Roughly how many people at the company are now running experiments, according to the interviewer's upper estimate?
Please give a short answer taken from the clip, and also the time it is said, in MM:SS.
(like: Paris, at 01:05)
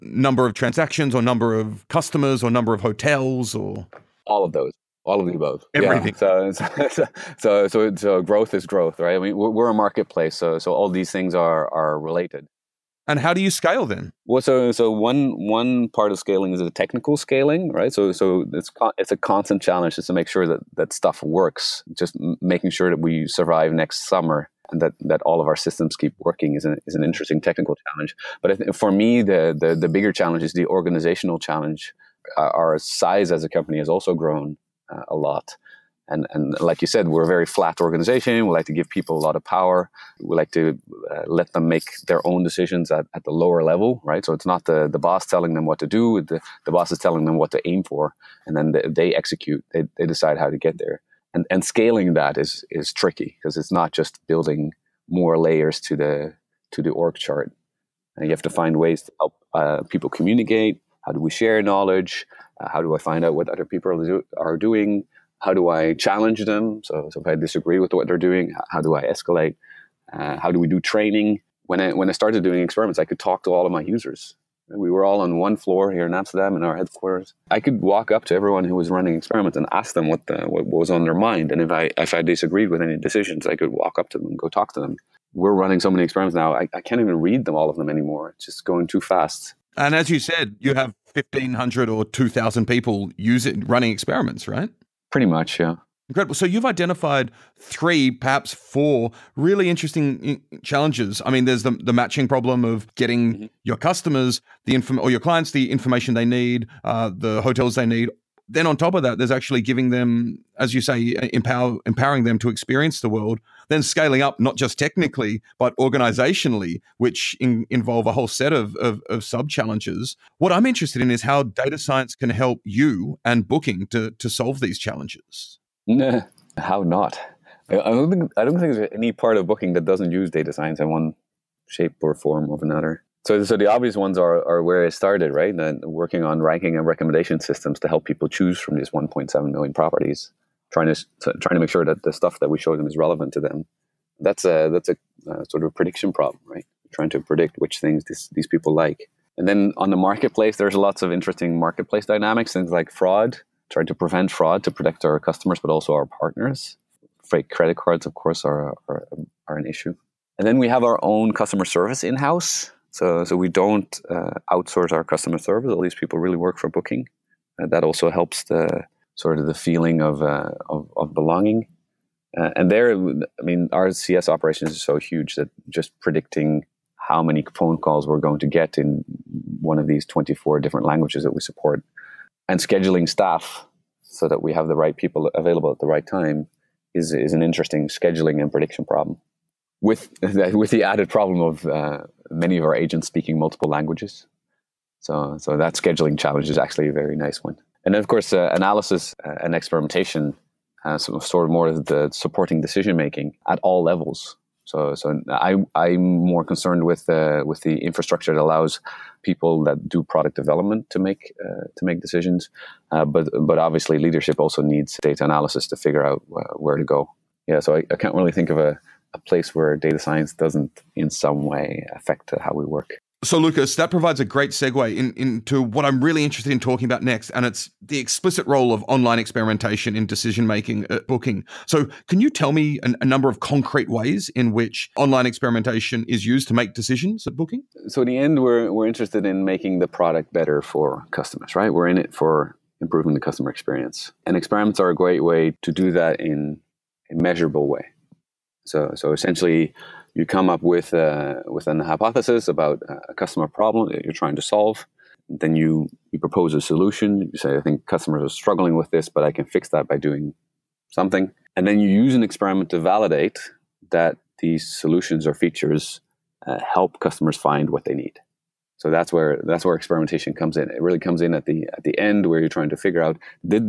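2,000, at 01:32.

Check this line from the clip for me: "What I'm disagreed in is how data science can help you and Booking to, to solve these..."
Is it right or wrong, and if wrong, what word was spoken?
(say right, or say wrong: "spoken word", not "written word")
wrong: "interested", not "disagreed".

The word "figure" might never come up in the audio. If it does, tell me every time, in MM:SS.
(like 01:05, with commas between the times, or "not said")
03:35, 04:32.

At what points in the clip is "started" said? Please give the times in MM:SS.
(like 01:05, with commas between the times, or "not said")
01:12, 02:14.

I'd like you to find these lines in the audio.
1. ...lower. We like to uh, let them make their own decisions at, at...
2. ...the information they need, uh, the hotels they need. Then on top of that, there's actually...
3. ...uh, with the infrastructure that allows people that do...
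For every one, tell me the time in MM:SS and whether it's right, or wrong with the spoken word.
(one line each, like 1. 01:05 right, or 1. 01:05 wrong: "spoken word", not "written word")
1. 00:39 wrong: "power", not "lower"
2. 01:45 right
3. 03:27 right.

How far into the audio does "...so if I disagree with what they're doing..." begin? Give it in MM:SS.
01:07.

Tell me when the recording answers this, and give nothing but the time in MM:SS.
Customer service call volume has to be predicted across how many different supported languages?
03:00.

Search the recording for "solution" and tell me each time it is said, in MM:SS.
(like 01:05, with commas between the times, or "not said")
04:16, 04:24.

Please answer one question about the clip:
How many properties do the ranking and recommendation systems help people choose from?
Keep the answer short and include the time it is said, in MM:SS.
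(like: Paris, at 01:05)
1.7 million, at 02:18.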